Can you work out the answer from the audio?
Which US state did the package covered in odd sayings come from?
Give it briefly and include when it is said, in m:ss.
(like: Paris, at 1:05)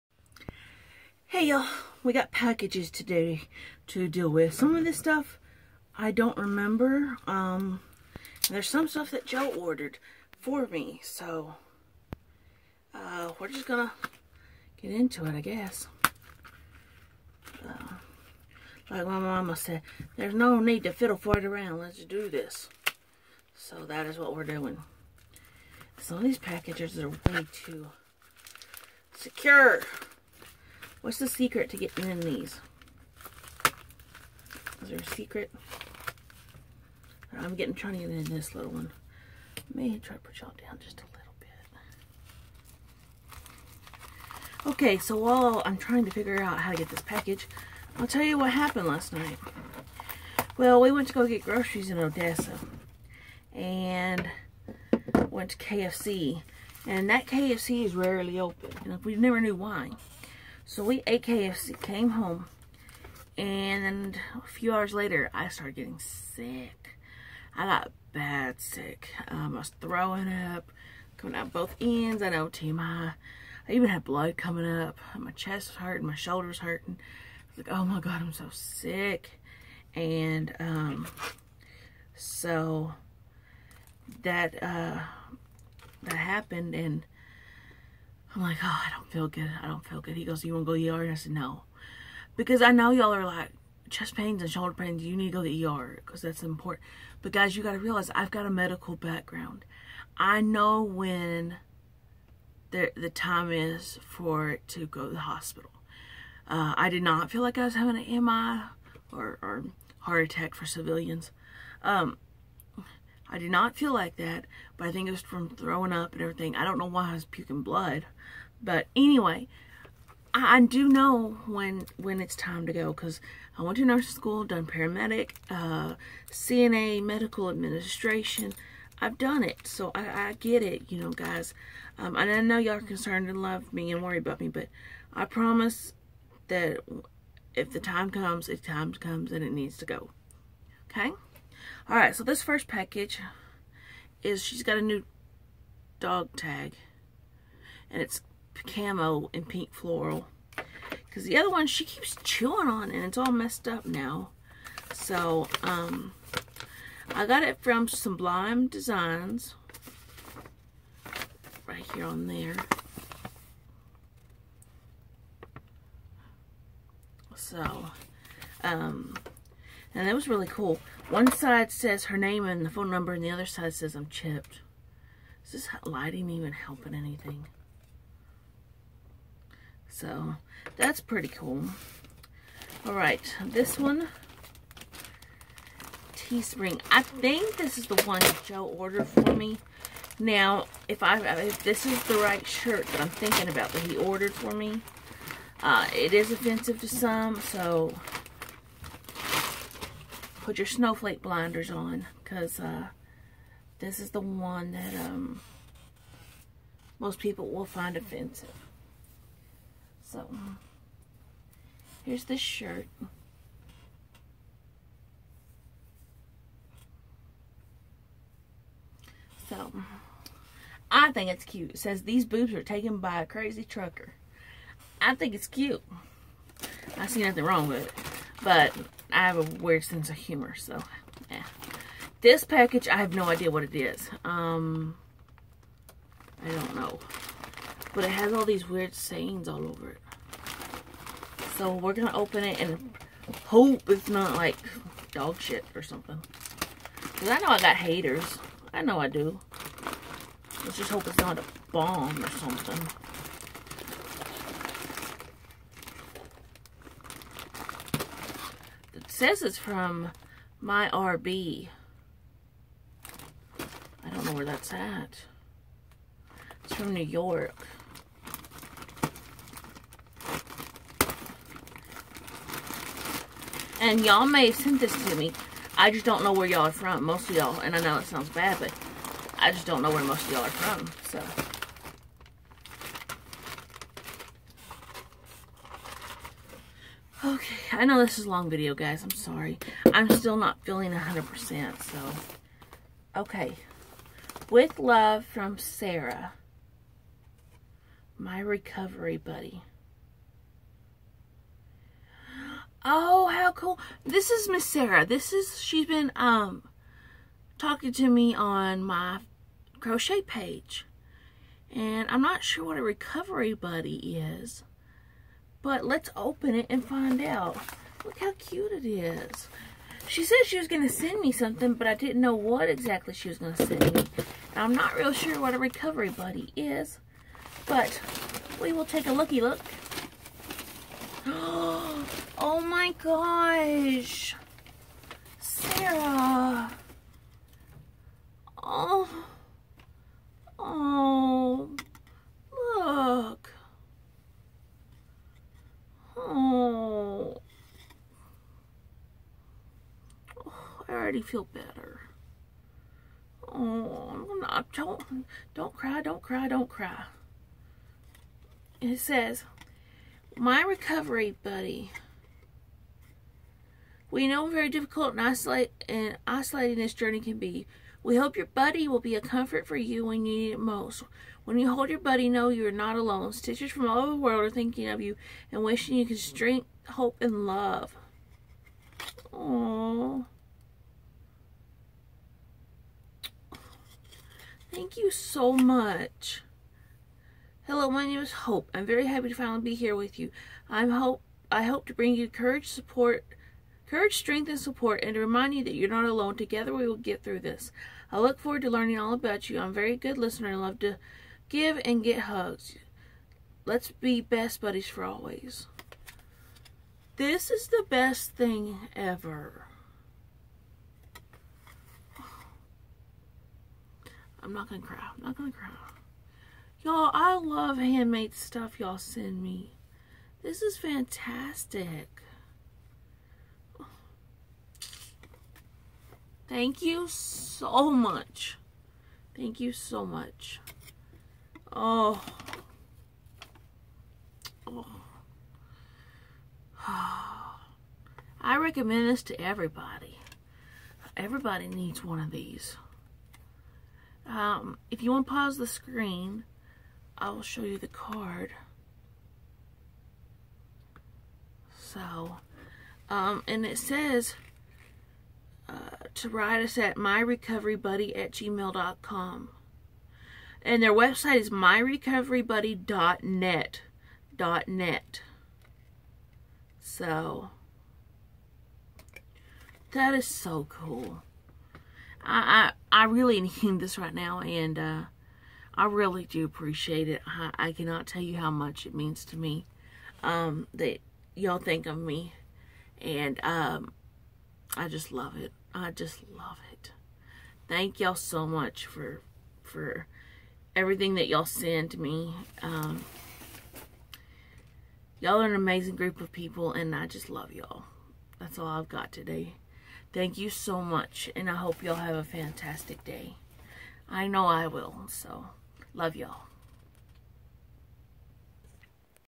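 New York, at 4:26.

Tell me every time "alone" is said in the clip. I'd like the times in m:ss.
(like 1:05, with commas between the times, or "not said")
6:12, 6:36.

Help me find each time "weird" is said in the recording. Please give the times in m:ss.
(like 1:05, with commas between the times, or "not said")
3:49, 3:58.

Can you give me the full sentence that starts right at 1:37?
But guys, you got to realize I've got a medical background.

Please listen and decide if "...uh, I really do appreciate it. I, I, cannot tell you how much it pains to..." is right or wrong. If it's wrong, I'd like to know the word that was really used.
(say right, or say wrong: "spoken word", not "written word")
wrong: "means", not "pains".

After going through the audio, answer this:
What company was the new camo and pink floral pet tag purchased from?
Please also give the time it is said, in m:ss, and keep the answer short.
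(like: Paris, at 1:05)
Sublime Designs, at 2:37.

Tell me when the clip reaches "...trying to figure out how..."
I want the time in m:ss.
0:45.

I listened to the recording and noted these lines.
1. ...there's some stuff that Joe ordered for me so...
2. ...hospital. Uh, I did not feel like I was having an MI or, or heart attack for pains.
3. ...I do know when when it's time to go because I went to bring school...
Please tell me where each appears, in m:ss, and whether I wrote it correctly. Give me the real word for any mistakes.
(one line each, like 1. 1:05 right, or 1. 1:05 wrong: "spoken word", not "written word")
1. 0:08 right
2. 1:45 wrong: "civilians", not "pains"
3. 2:00 wrong: "nursing", not "bring".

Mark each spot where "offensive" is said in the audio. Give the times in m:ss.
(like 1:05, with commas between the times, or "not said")
3:16, 3:27.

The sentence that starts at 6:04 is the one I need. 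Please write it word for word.
We know very difficult and, isolate, and isolating this journey can be.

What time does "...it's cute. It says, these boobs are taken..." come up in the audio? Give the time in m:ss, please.
3:41.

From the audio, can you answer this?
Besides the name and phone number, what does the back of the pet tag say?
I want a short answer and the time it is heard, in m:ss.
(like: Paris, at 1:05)
I'm chipped, at 2:53.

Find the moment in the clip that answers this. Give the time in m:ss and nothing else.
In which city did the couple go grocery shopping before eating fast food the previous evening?
0:51.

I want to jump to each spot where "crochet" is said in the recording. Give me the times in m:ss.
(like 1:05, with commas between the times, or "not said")
5:09.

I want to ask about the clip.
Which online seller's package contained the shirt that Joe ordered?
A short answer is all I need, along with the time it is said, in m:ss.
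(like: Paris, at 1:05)
Teespring, at 3:06.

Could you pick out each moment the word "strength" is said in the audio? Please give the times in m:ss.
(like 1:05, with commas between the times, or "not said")
6:16, 6:34.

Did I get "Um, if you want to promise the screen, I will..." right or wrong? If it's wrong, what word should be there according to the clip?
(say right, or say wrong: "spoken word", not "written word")
wrong: "pause", not "promise".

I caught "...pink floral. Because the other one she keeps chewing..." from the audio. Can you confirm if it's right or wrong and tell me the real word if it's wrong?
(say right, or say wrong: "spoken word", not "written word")
right.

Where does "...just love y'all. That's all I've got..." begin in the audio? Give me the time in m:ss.
8:17.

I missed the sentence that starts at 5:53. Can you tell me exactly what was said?
Oh, not, don't, don't cry, don't cry, don't cry.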